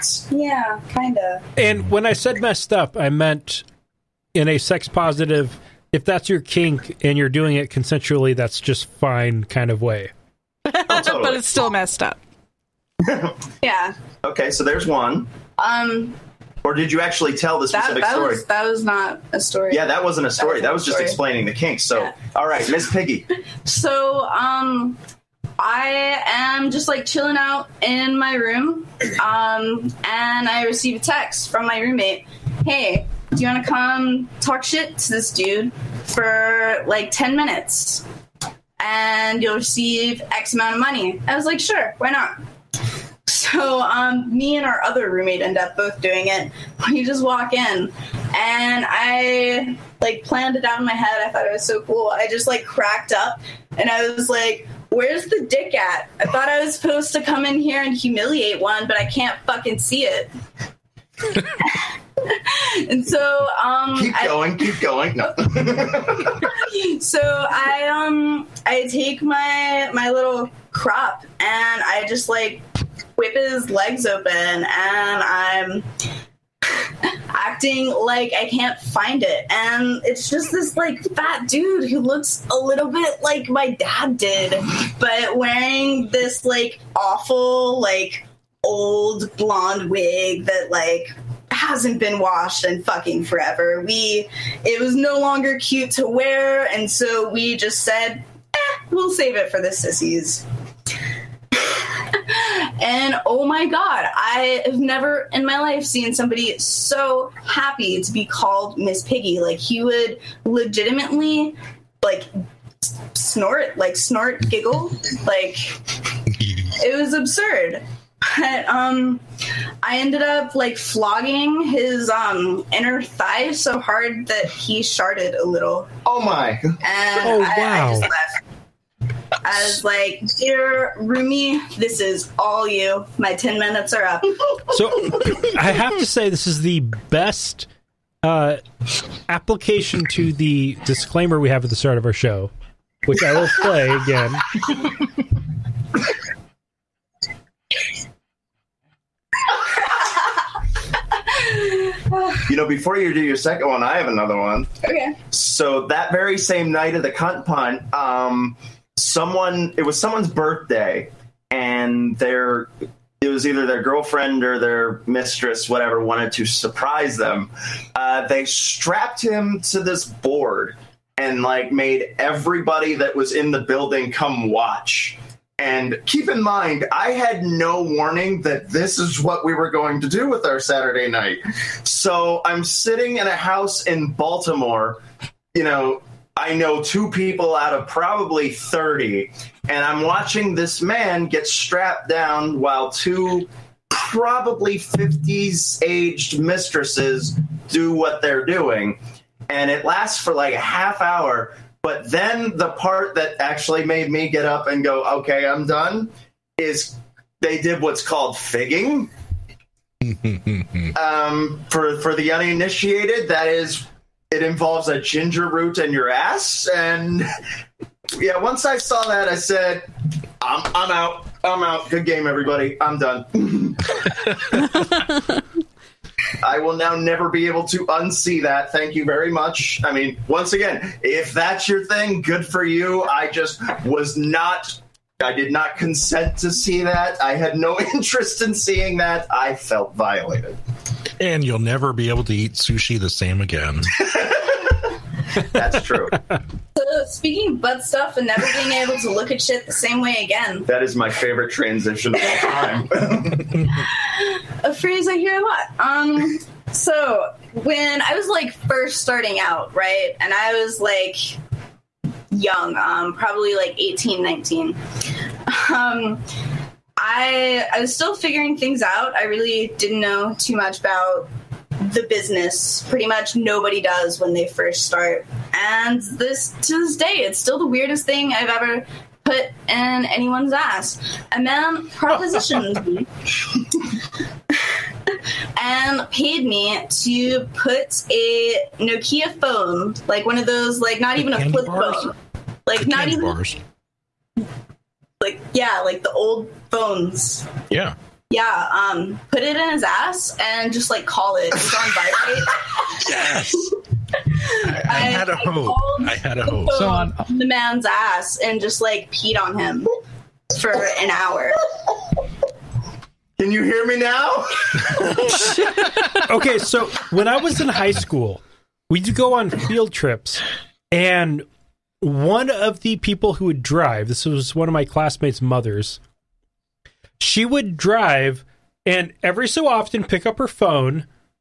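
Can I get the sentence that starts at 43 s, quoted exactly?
So um, me and our other roommate end up both doing it.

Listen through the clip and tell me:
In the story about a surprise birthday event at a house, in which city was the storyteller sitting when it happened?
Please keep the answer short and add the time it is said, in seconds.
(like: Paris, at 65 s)
Baltimore, at 184 s.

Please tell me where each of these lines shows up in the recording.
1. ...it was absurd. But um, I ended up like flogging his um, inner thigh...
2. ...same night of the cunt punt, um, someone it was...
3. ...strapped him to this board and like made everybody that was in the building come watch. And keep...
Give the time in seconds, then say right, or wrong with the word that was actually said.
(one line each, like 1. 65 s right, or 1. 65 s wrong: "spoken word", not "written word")
1. 116 s right
2. 156 s right
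3. 168 s right.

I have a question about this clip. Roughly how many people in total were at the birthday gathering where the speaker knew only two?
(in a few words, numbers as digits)
30.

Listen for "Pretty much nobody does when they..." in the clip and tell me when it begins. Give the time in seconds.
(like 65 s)
272 s.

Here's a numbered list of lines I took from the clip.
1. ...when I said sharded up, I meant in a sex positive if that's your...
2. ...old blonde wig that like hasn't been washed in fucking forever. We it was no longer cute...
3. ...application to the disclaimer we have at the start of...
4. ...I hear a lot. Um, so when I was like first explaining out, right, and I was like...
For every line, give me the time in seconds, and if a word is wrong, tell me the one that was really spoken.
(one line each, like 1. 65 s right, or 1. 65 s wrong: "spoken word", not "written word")
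1. 1 s wrong: "messed", not "sharded"
2. 88 s right
3. 139 s right
4. 255 s wrong: "starting", not "explaining".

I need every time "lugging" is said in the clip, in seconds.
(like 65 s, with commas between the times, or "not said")
not said.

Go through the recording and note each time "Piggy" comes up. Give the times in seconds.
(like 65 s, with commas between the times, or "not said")
22 s, 109 s.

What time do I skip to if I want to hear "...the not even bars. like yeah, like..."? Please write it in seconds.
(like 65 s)
292 s.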